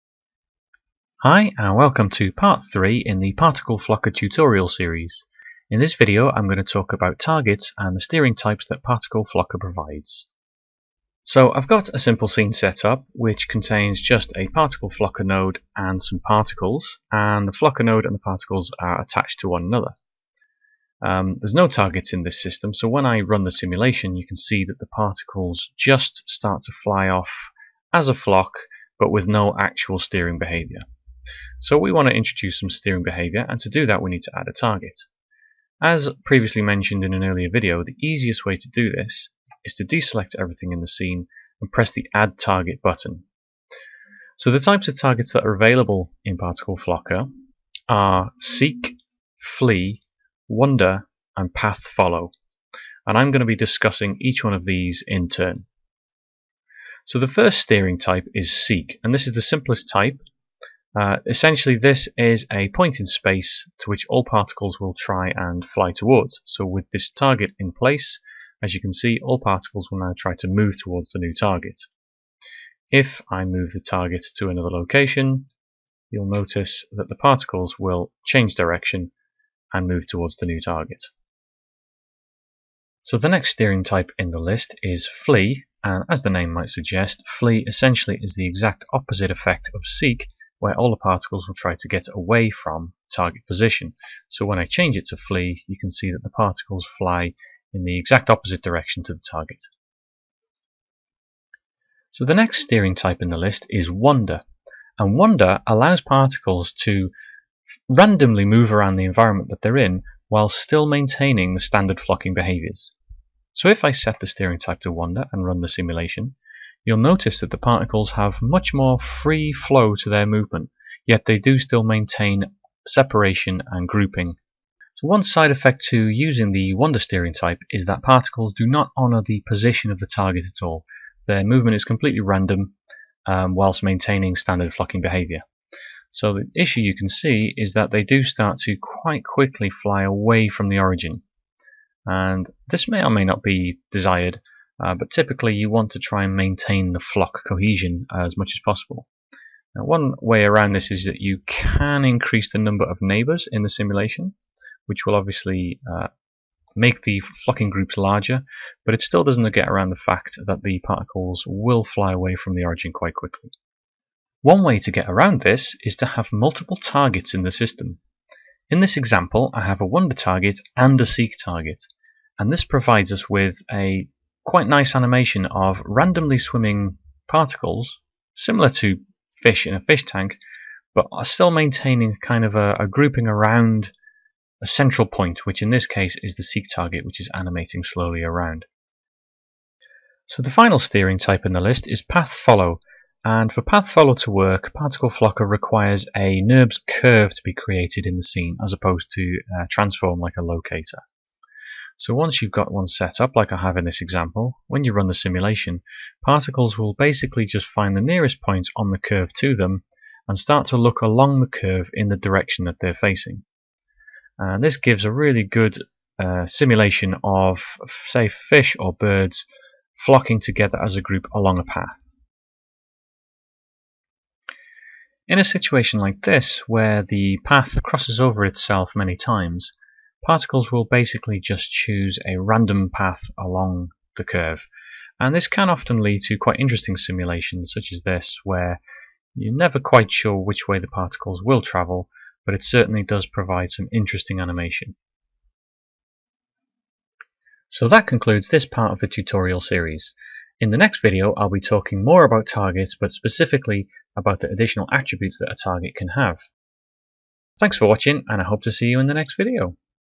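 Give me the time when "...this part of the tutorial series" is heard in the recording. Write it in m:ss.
4:08.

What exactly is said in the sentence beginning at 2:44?
One way to get around this is to have multiple targets in the system.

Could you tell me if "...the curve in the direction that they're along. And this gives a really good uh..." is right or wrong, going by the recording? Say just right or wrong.
wrong.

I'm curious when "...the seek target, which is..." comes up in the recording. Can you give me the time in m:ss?
3:06.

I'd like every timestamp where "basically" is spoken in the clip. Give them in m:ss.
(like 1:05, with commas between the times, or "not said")
3:26, 3:50.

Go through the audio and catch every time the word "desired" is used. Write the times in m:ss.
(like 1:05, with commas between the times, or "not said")
2:23.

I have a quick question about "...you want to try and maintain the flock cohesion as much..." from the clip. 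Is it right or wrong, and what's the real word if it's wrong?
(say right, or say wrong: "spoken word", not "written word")
right.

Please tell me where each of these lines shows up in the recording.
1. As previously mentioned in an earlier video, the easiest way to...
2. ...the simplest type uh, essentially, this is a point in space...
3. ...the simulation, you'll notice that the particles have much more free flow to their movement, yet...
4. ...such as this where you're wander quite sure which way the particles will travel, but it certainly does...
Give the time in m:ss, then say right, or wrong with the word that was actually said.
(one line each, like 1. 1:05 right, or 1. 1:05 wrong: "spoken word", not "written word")
1. 0:35 right
2. 0:59 right
3. 1:55 right
4. 3:57 wrong: "never", not "wander".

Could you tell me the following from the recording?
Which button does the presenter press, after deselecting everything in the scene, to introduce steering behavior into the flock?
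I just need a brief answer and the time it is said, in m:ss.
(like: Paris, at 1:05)
Add Target, at 0:42.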